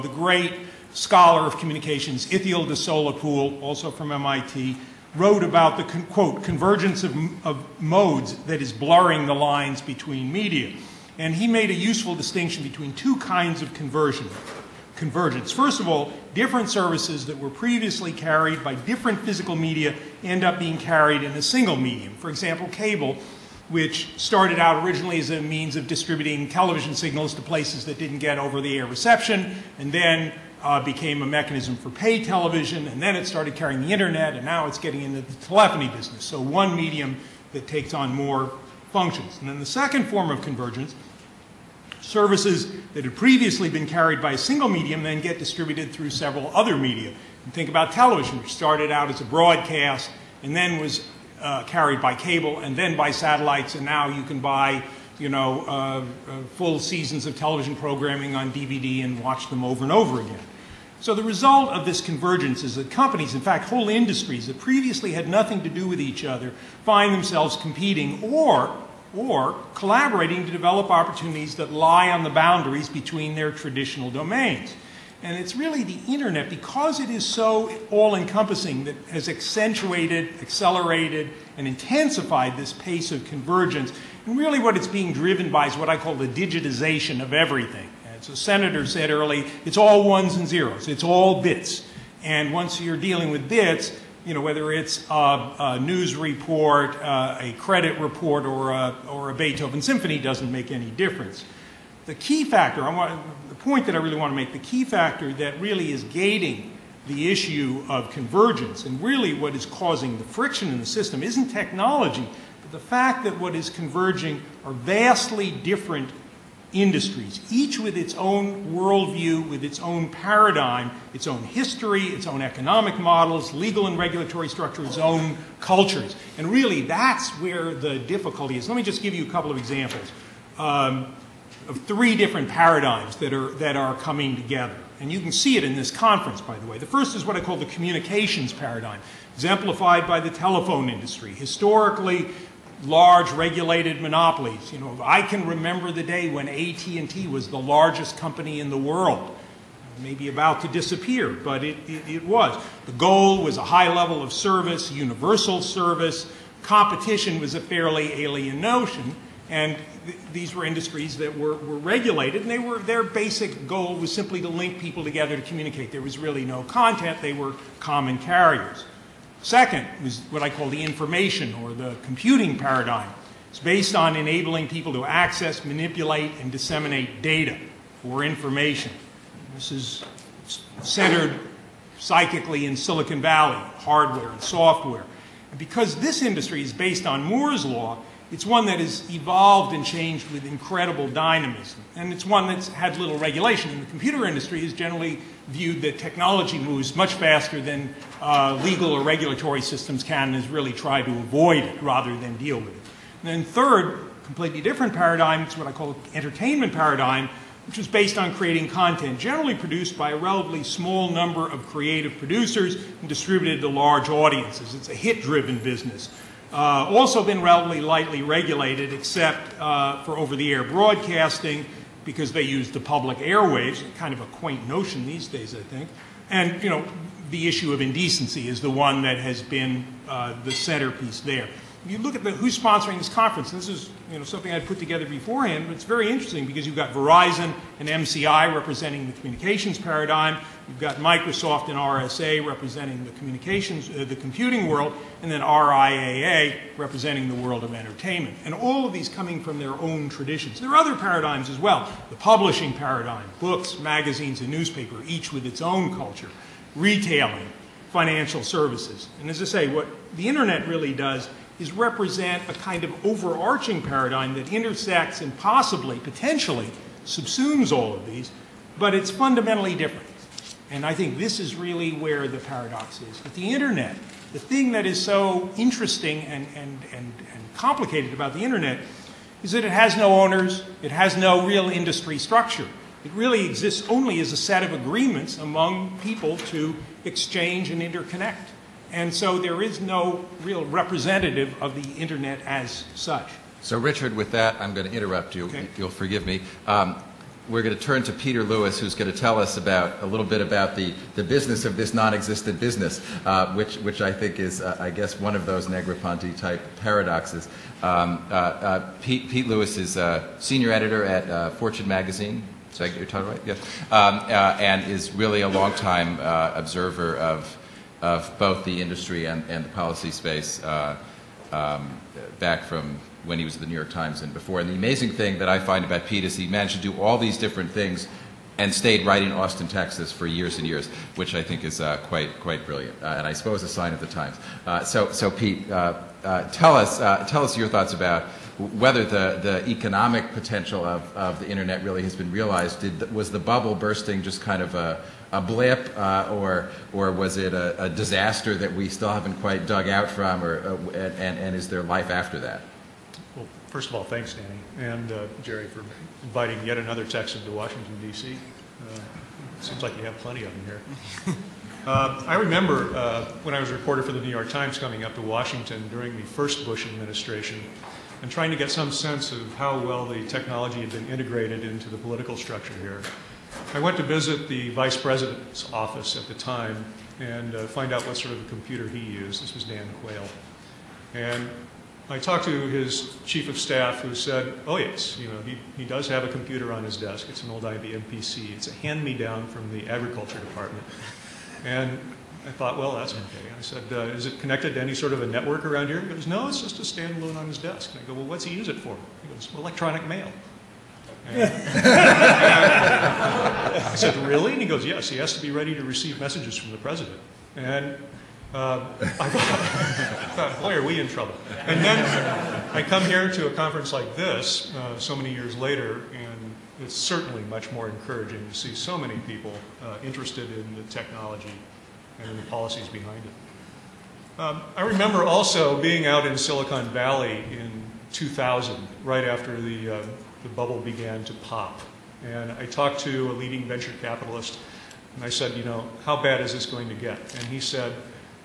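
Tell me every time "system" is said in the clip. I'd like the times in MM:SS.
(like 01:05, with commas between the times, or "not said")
01:50, 03:19.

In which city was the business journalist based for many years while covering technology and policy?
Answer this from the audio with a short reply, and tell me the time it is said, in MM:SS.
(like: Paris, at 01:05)
Austin, Texas, at 05:29.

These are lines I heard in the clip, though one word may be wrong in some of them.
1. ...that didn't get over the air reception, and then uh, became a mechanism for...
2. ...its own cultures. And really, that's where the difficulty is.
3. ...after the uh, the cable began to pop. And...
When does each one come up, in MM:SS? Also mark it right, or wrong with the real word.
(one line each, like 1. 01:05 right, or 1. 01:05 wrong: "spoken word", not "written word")
1. 00:27 right
2. 02:04 right
3. 07:09 wrong: "bubble", not "cable".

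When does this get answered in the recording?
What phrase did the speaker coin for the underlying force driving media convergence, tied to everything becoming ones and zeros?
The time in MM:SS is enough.
01:26.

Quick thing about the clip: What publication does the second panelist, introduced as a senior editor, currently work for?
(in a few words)
Fortune.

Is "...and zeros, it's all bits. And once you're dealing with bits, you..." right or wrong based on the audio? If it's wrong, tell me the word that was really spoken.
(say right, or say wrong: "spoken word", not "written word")
right.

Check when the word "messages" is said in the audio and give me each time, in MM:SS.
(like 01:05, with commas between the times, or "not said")
06:46.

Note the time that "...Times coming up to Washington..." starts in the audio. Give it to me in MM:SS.
06:04.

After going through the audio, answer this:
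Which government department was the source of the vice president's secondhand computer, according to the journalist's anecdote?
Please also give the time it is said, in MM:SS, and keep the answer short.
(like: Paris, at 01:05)
Agriculture department, at 06:29.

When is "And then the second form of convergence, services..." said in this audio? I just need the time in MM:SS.
00:39.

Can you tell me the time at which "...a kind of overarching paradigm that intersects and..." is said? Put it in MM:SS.
04:22.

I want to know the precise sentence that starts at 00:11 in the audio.
And he made a useful distinction between two kinds of conversion, convergence.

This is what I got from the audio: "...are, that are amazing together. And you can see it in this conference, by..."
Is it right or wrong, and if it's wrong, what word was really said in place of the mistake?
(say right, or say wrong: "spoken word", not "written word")
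wrong: "coming", not "amazing".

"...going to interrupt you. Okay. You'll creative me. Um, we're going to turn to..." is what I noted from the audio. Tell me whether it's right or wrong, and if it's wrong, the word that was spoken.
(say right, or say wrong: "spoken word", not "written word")
wrong: "forgive", not "creative".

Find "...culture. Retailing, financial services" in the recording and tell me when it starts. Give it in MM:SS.
04:15.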